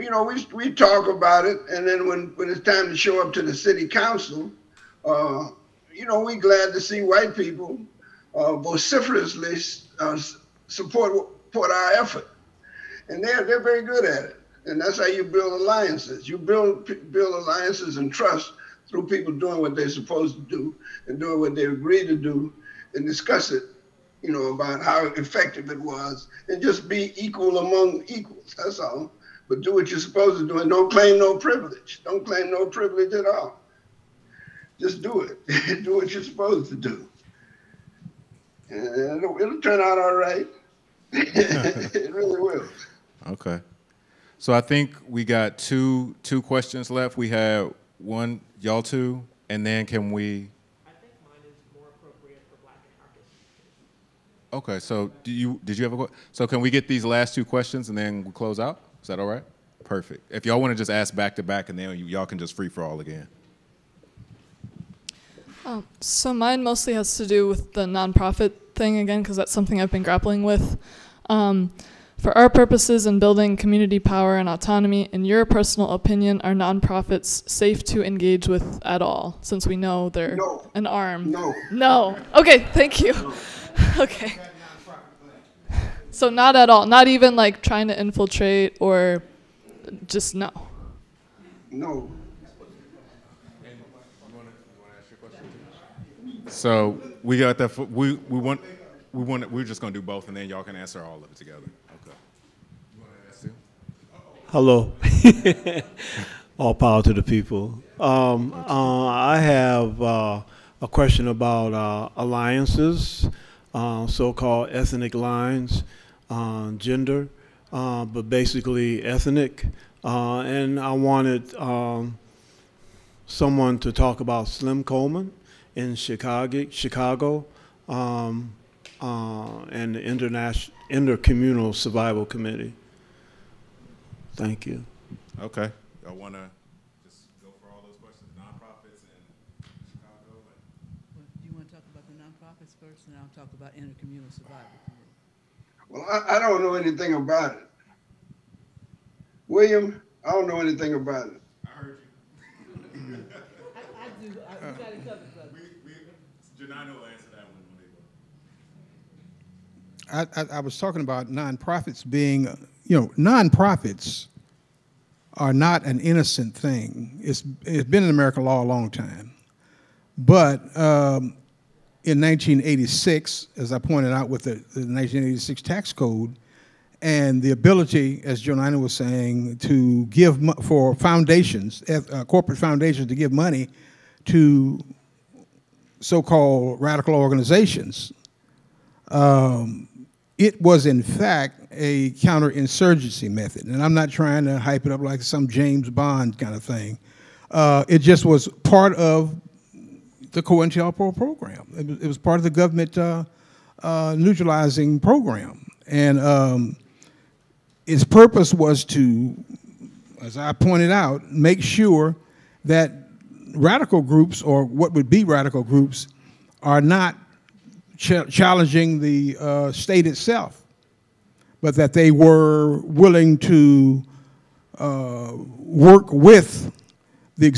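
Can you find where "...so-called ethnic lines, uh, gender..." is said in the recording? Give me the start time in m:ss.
1:54.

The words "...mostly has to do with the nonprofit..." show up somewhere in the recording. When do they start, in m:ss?
1:06.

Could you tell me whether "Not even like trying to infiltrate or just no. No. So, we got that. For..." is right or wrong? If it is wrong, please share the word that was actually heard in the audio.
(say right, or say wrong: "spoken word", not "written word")
right.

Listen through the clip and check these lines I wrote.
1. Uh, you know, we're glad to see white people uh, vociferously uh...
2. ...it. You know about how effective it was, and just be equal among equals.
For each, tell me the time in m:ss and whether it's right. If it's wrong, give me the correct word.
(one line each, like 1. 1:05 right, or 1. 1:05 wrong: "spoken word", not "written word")
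1. 0:05 right
2. 0:23 right.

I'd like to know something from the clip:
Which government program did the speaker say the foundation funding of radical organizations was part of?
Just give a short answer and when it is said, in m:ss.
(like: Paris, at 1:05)
COINTELPRO, at 3:20.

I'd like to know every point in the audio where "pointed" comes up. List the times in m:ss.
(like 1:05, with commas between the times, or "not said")
2:53, 3:30.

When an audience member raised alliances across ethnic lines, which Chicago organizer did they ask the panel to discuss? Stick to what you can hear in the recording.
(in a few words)
Slim Coleman.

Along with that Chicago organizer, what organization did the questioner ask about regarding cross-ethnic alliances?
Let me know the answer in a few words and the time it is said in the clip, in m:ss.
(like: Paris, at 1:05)
International Intercommunal Survival Committee, at 2:10.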